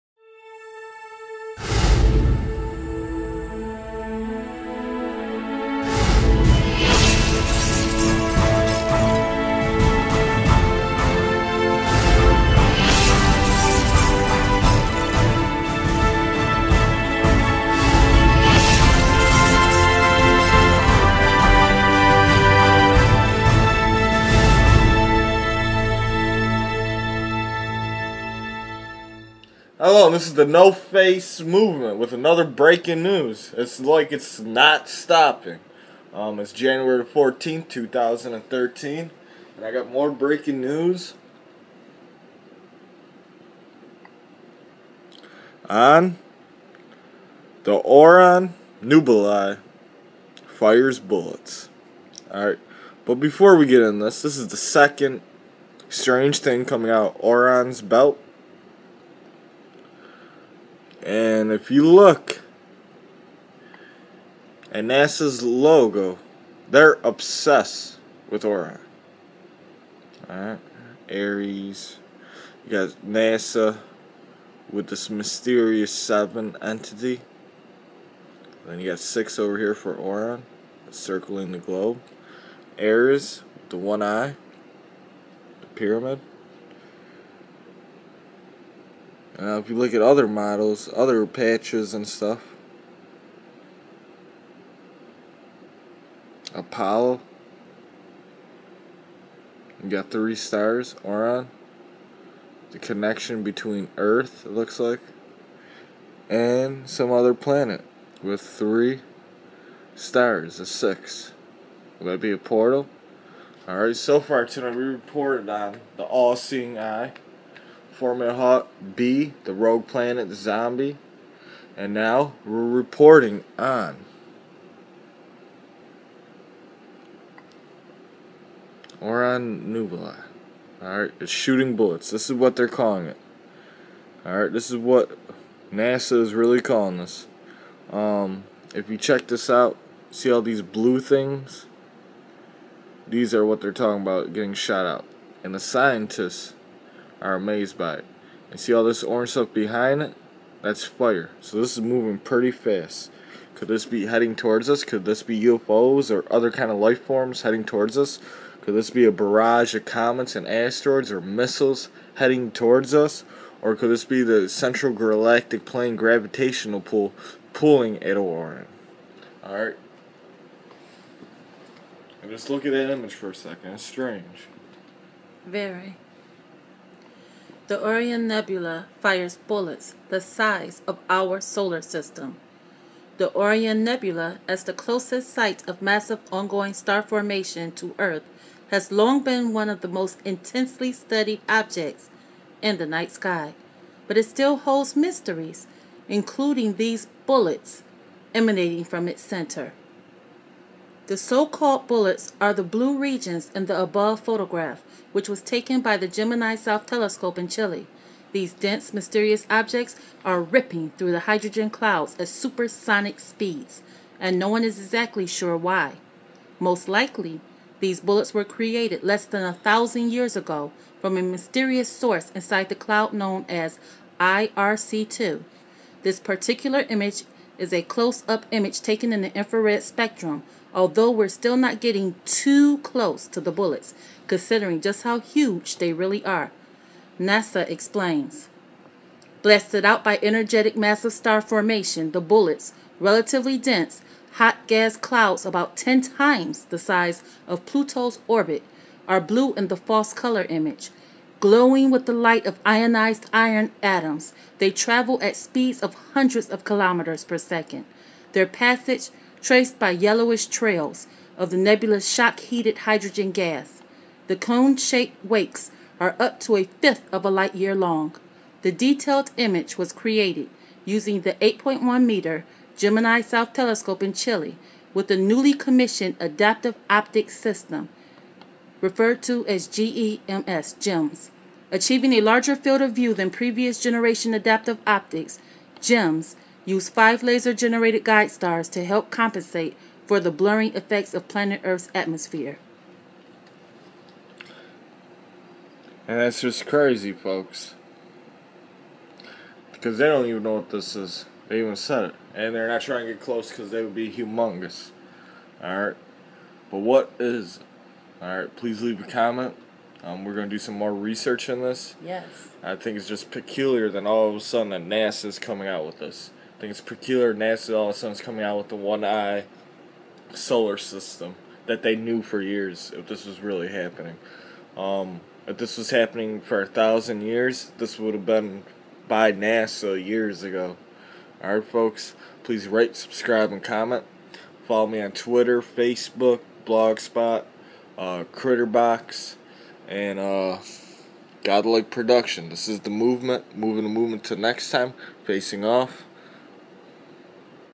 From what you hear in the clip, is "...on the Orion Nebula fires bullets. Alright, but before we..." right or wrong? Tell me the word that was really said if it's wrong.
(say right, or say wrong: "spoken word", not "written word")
right.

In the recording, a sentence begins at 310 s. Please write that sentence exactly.
Um, we're going to do some more research in this.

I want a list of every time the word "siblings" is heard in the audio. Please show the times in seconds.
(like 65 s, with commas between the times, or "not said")
not said.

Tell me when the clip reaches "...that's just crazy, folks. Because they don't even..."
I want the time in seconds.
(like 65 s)
296 s.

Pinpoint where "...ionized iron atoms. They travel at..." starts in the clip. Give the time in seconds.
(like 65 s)
252 s.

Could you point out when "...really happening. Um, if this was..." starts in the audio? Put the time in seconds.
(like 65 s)
323 s.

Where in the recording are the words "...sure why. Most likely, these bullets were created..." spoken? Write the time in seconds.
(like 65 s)
215 s.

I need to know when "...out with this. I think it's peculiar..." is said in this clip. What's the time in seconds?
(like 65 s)
315 s.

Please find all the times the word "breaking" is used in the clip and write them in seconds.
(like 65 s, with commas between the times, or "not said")
32 s, 40 s.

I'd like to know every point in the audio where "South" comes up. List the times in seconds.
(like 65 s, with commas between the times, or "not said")
206 s, 273 s.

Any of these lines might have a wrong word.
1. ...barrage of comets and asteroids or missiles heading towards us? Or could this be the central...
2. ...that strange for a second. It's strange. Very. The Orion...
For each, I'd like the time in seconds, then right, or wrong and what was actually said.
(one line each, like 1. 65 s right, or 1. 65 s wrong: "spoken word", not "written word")
1. 159 s right
2. 172 s wrong: "image", not "strange".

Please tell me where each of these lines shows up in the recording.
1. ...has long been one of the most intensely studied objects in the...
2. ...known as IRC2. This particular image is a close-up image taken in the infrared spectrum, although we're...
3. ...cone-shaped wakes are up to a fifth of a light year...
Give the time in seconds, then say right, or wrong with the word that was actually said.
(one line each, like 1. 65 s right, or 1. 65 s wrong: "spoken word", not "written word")
1. 188 s right
2. 223 s right
3. 264 s right.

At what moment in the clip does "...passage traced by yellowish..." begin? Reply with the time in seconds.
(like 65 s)
258 s.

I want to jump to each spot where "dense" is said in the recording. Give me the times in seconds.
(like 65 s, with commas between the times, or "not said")
208 s, 243 s.